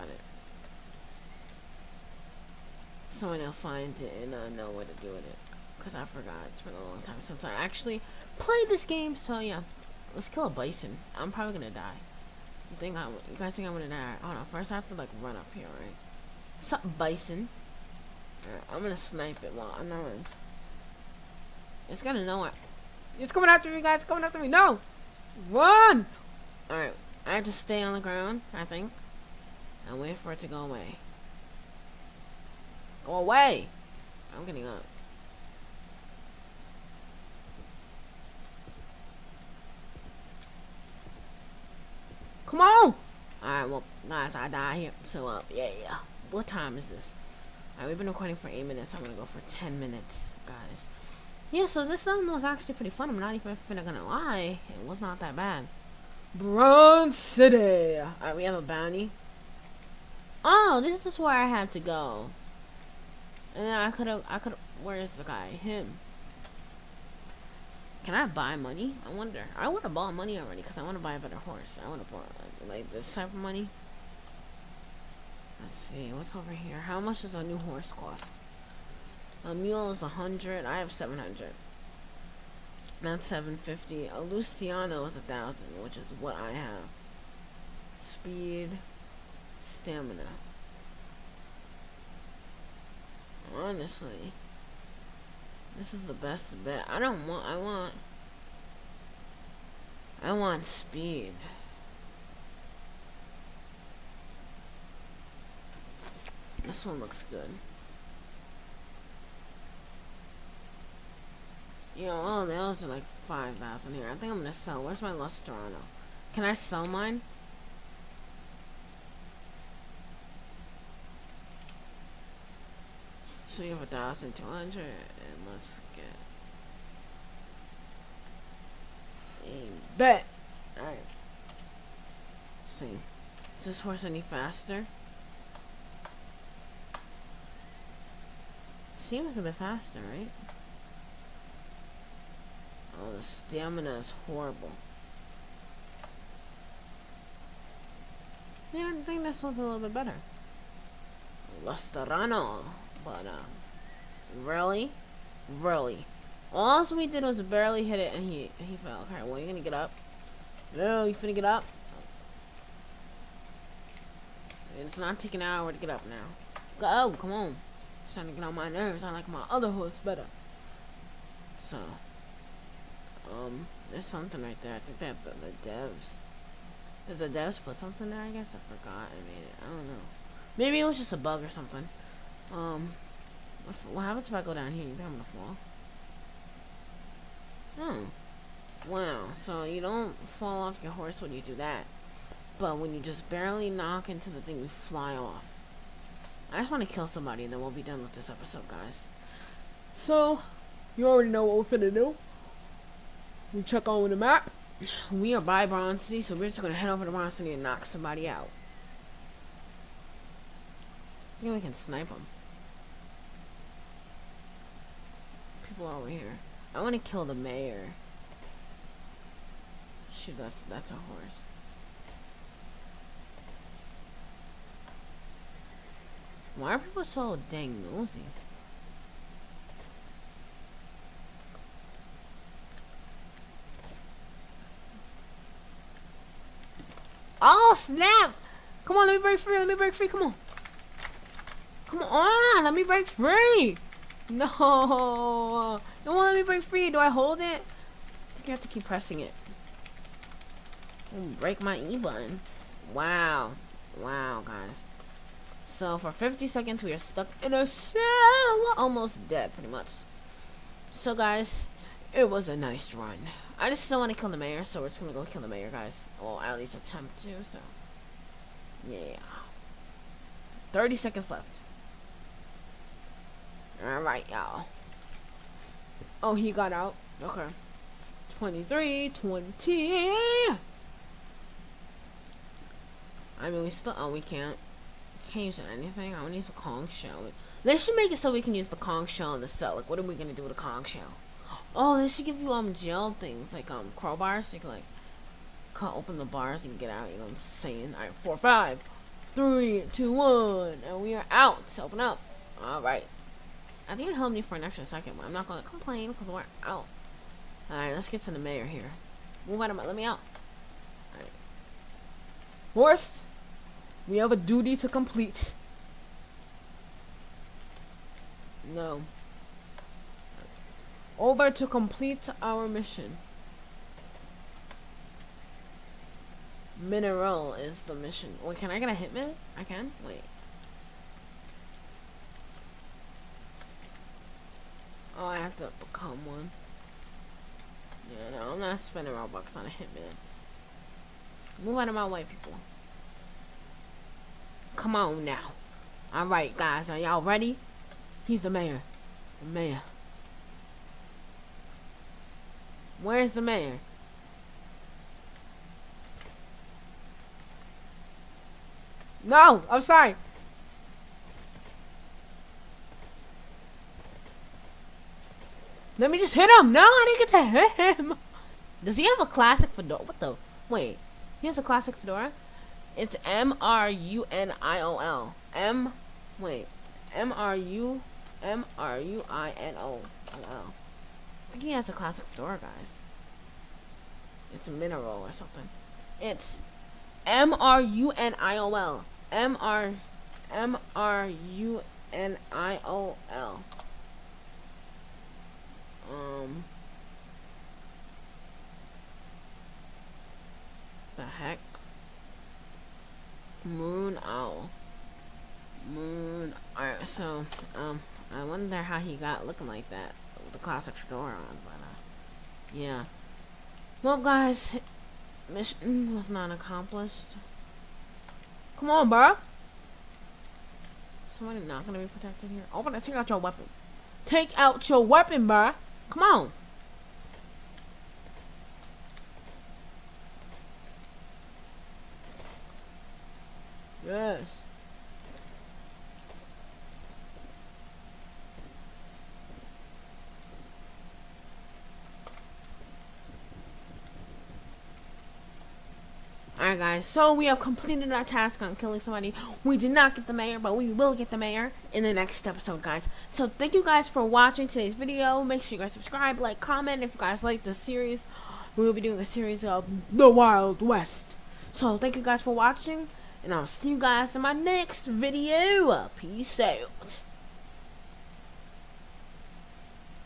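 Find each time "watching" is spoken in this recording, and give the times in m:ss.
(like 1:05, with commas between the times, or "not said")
7:34, 7:42.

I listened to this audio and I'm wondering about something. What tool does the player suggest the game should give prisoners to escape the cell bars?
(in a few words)
crowbars.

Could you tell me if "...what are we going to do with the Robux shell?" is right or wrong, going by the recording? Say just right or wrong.
wrong.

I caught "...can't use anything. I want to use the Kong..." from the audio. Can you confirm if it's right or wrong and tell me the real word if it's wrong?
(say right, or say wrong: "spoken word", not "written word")
right.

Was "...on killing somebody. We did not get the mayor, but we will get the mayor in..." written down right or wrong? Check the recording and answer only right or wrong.
right.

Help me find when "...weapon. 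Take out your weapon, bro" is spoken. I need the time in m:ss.
7:03.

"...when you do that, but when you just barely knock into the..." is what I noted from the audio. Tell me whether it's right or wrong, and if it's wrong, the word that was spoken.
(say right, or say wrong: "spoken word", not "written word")
right.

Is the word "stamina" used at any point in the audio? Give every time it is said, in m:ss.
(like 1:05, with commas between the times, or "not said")
1:29, 2:23.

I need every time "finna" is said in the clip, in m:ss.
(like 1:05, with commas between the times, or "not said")
0:53, 2:41, 3:21.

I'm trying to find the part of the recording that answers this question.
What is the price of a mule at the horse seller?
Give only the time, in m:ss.
1:19.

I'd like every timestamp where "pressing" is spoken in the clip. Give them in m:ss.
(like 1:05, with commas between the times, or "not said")
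4:08.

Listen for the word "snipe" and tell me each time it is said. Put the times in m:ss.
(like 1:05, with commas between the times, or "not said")
0:18, 3:31.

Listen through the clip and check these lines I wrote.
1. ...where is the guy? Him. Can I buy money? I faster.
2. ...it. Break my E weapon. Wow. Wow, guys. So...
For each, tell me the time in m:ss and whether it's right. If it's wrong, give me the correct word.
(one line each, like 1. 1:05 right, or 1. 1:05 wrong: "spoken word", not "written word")
1. 1:04 wrong: "wonder", not "faster"
2. 4:09 wrong: "button", not "weapon".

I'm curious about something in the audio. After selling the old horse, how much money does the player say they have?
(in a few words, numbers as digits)
1,200.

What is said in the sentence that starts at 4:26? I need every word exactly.
Well, at least attempt to, so.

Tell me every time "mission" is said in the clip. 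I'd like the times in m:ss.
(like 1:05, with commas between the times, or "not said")
5:22, 5:27, 6:55.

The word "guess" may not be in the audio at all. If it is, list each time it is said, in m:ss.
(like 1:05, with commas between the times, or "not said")
2:58.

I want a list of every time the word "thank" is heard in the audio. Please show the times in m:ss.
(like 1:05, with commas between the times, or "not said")
7:33, 7:41.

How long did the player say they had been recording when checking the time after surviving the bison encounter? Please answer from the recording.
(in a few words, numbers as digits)
8 minutes.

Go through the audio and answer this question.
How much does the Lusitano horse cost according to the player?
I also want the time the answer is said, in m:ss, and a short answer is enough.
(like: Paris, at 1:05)
1,000, at 1:24.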